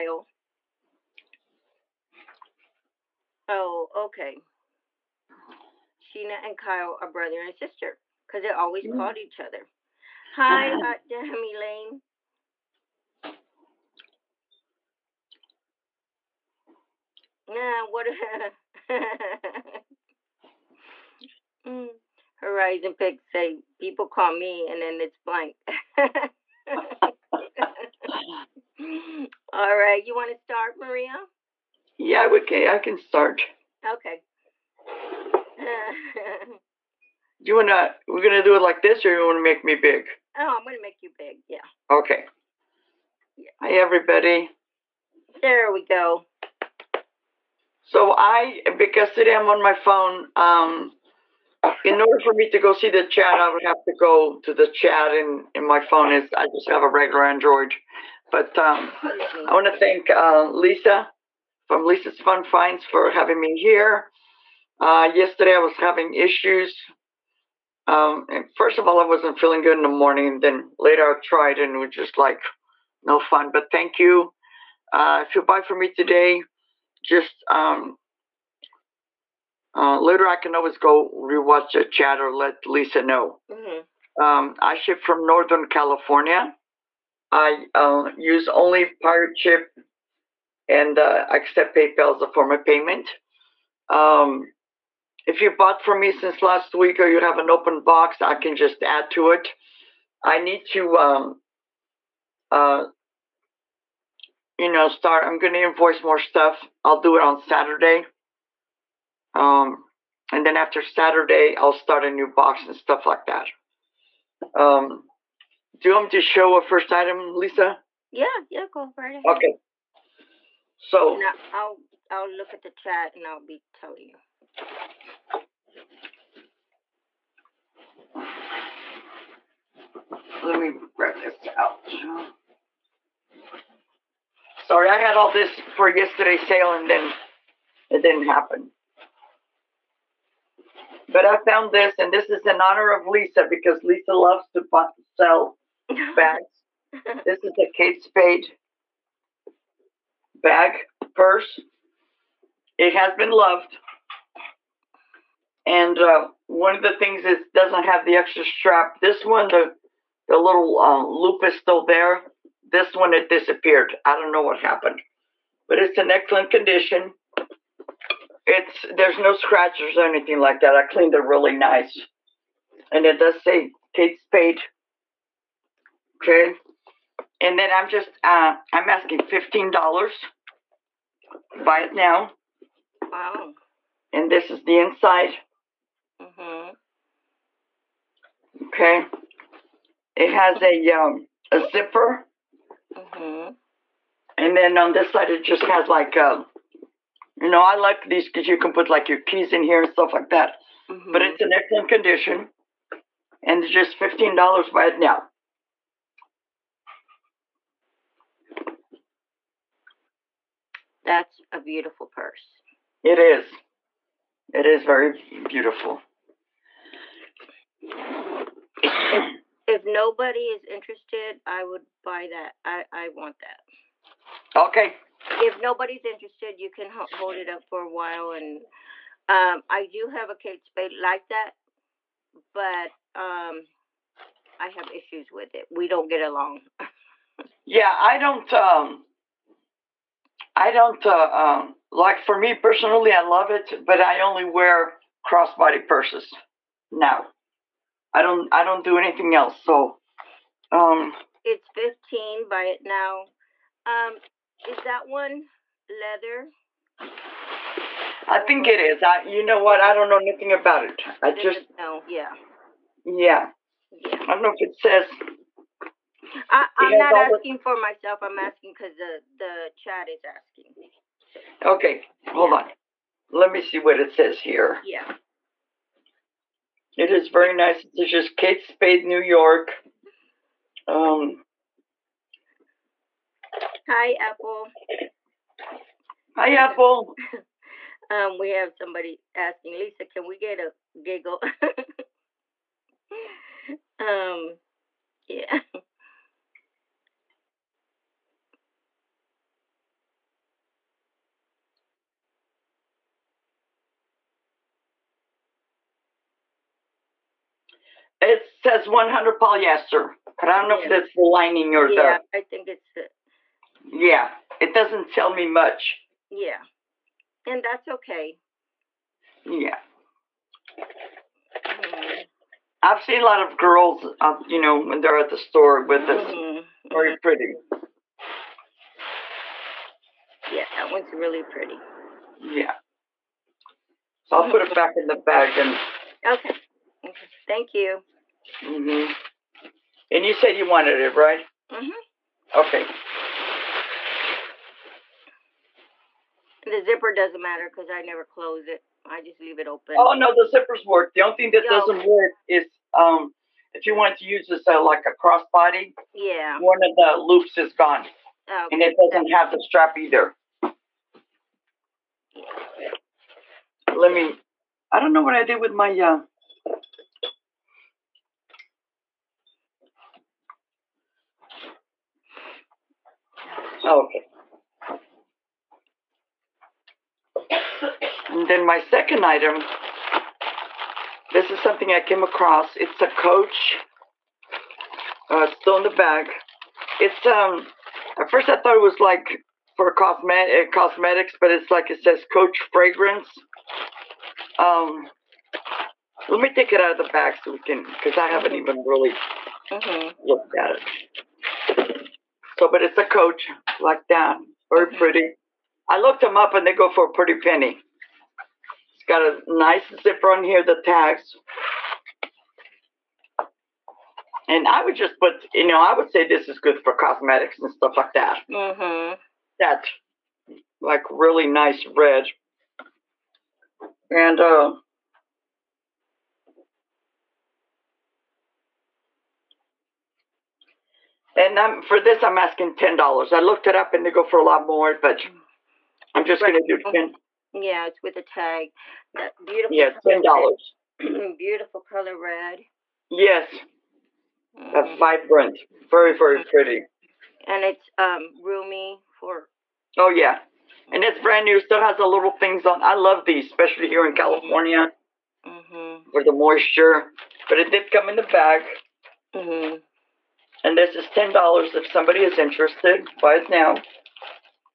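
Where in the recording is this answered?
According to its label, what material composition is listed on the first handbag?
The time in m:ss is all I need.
5:08.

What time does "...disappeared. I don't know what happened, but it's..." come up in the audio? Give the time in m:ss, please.
2:43.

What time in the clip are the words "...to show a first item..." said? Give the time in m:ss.
1:56.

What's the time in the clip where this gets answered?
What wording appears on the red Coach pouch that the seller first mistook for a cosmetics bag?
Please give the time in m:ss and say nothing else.
6:32.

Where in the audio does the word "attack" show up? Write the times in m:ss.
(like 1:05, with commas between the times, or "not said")
not said.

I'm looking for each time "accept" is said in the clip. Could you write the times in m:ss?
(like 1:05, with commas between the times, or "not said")
1:31.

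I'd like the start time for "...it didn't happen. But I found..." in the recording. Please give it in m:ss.
2:17.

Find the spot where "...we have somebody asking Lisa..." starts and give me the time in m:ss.
4:48.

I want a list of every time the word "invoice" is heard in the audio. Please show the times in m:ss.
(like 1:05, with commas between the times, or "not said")
1:45.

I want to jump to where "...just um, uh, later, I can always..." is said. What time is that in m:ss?
1:17.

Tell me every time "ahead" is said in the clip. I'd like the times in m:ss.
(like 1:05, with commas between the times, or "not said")
1:59.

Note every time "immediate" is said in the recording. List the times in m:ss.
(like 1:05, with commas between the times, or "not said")
not said.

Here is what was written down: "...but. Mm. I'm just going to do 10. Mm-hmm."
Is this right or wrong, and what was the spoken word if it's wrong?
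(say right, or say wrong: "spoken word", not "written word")
right.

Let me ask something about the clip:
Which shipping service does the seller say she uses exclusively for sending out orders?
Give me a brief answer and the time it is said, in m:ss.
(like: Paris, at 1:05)
Pirate Ship, at 1:29.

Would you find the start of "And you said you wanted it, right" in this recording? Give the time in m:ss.
5:40.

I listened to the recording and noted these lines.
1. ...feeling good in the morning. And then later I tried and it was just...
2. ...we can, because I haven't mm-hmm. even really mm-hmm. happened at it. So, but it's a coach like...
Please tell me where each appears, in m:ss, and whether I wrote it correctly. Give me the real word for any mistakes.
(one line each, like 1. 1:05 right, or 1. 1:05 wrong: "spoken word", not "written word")
1. 1:09 right
2. 6:37 wrong: "looked", not "happened".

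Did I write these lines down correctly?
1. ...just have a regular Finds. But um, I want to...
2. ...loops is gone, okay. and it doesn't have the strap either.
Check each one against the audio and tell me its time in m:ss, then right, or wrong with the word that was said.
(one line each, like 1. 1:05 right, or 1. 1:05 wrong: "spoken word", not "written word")
1. 0:56 wrong: "Android", not "Finds"
2. 5:57 right.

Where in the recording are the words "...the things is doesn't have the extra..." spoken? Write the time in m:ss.
2:36.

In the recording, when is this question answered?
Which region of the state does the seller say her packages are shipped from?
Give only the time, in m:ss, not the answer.
1:25.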